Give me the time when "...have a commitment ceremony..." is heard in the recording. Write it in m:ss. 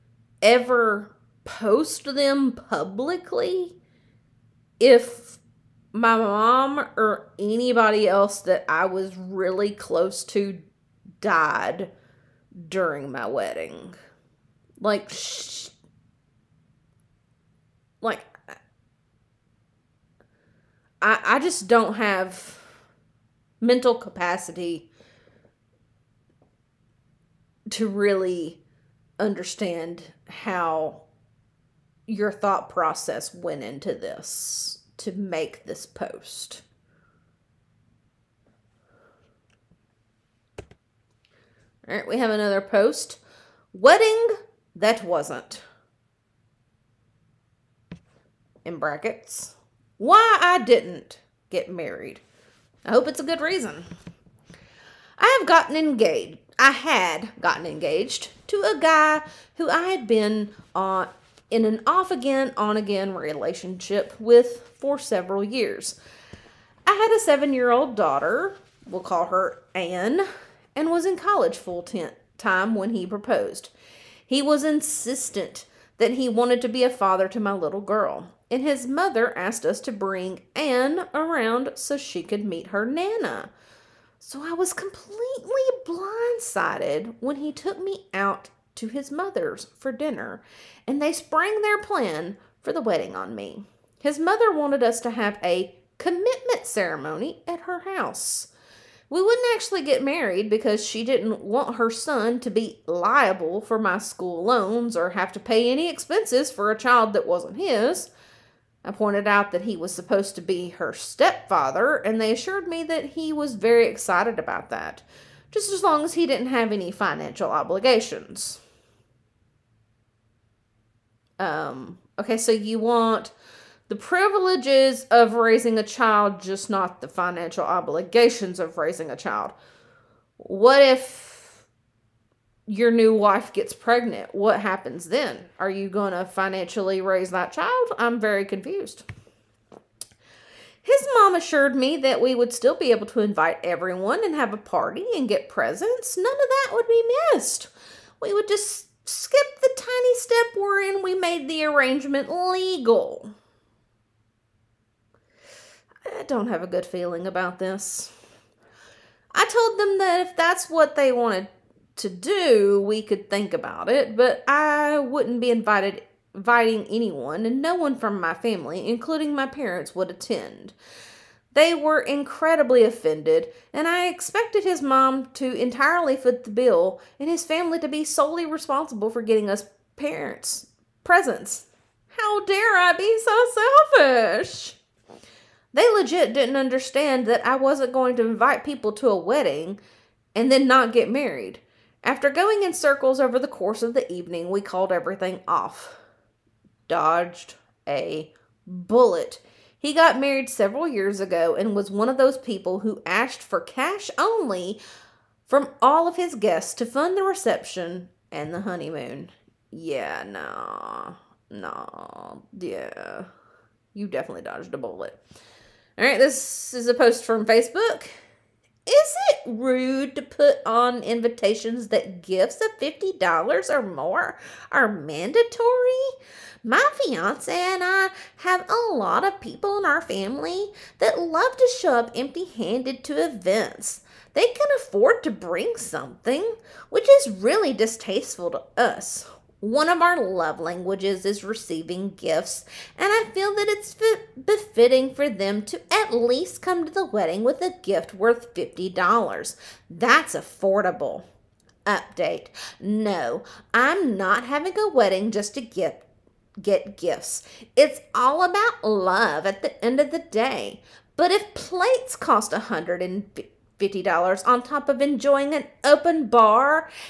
1:35.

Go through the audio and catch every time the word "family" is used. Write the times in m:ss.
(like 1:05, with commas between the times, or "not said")
2:48, 2:57, 3:50.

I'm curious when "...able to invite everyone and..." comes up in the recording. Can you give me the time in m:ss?
2:22.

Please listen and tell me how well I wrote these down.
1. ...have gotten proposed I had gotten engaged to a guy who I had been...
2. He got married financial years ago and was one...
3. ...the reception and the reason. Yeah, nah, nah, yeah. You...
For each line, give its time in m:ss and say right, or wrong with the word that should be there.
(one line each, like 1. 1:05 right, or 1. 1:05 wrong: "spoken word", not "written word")
1. 0:55 wrong: "engaged", not "proposed"
2. 3:19 wrong: "several", not "financial"
3. 3:27 wrong: "honeymoon", not "reason".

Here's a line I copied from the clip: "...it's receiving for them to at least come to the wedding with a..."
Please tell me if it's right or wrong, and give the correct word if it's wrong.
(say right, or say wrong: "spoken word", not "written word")
wrong: "befitting", not "receiving".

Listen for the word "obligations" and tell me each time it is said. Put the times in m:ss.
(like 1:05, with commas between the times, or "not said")
1:57, 2:07.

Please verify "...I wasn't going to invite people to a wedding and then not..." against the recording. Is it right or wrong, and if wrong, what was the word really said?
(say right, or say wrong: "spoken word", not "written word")
right.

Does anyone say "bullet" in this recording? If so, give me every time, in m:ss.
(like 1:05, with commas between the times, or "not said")
3:18, 3:34.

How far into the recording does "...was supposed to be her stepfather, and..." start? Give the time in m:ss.
1:49.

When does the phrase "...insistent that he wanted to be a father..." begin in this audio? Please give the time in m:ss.
1:14.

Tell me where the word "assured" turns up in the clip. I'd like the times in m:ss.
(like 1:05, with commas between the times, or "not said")
1:52, 2:21.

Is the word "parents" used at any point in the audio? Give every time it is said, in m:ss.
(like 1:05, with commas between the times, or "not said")
2:49, 2:59.